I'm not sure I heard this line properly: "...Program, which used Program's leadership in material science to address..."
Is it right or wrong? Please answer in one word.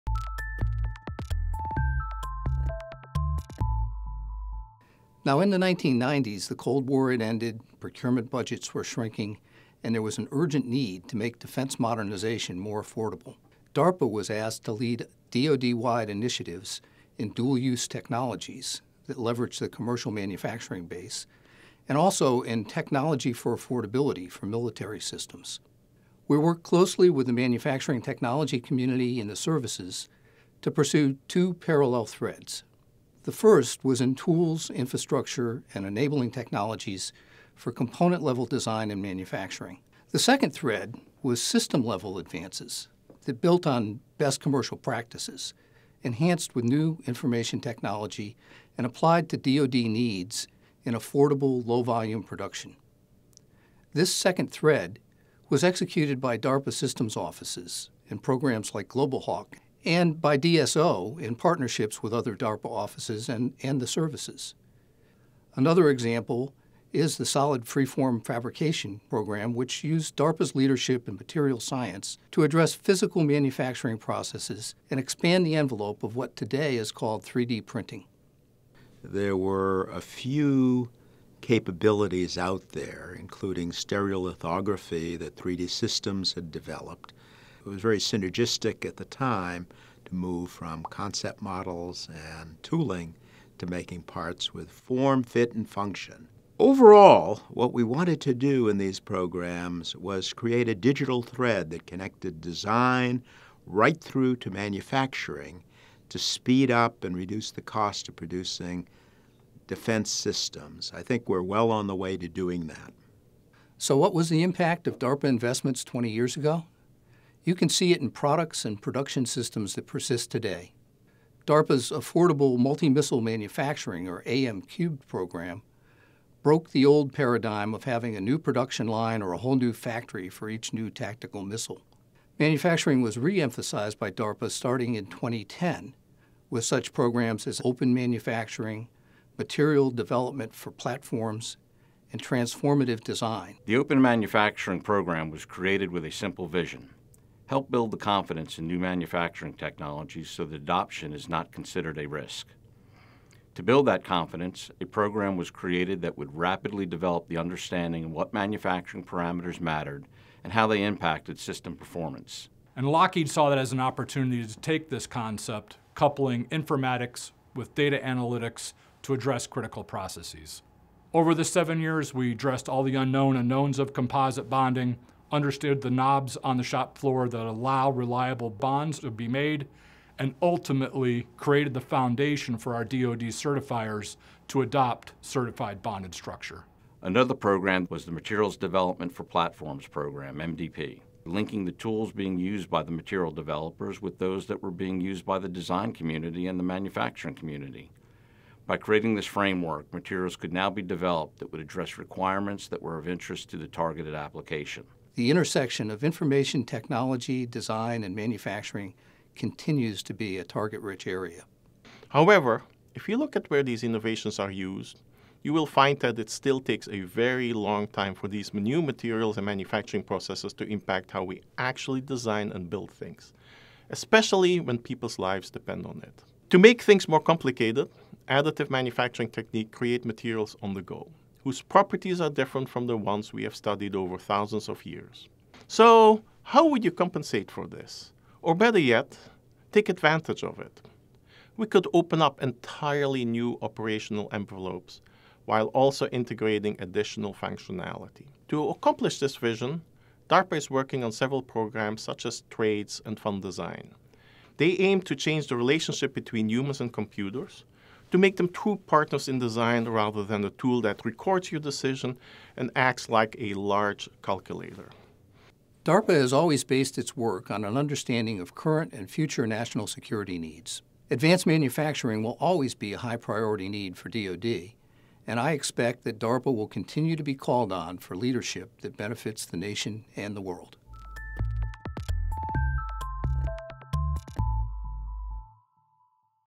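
wrong.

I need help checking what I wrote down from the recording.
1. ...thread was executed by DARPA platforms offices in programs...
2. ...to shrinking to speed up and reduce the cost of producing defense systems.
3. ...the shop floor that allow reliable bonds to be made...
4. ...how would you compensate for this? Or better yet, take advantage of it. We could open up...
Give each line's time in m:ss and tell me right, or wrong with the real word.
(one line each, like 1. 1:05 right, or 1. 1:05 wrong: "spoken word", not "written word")
1. 0:54 wrong: "systems", not "platforms"
2. 1:44 wrong: "manufacturing", not "shrinking"
3. 2:56 right
4. 3:56 right.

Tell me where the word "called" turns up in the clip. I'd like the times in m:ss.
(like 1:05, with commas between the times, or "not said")
1:16, 4:37.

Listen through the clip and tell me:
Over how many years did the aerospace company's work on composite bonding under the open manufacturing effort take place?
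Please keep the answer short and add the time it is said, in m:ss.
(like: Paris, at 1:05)
7, at 2:51.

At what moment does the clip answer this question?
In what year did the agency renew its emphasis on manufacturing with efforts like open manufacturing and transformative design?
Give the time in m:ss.
2:15.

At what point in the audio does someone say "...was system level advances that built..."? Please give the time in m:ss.
0:41.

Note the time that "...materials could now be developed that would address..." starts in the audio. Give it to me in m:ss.
3:19.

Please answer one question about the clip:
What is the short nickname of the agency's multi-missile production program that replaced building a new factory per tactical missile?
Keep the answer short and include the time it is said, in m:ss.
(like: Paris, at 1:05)
AM Cubed, at 2:04.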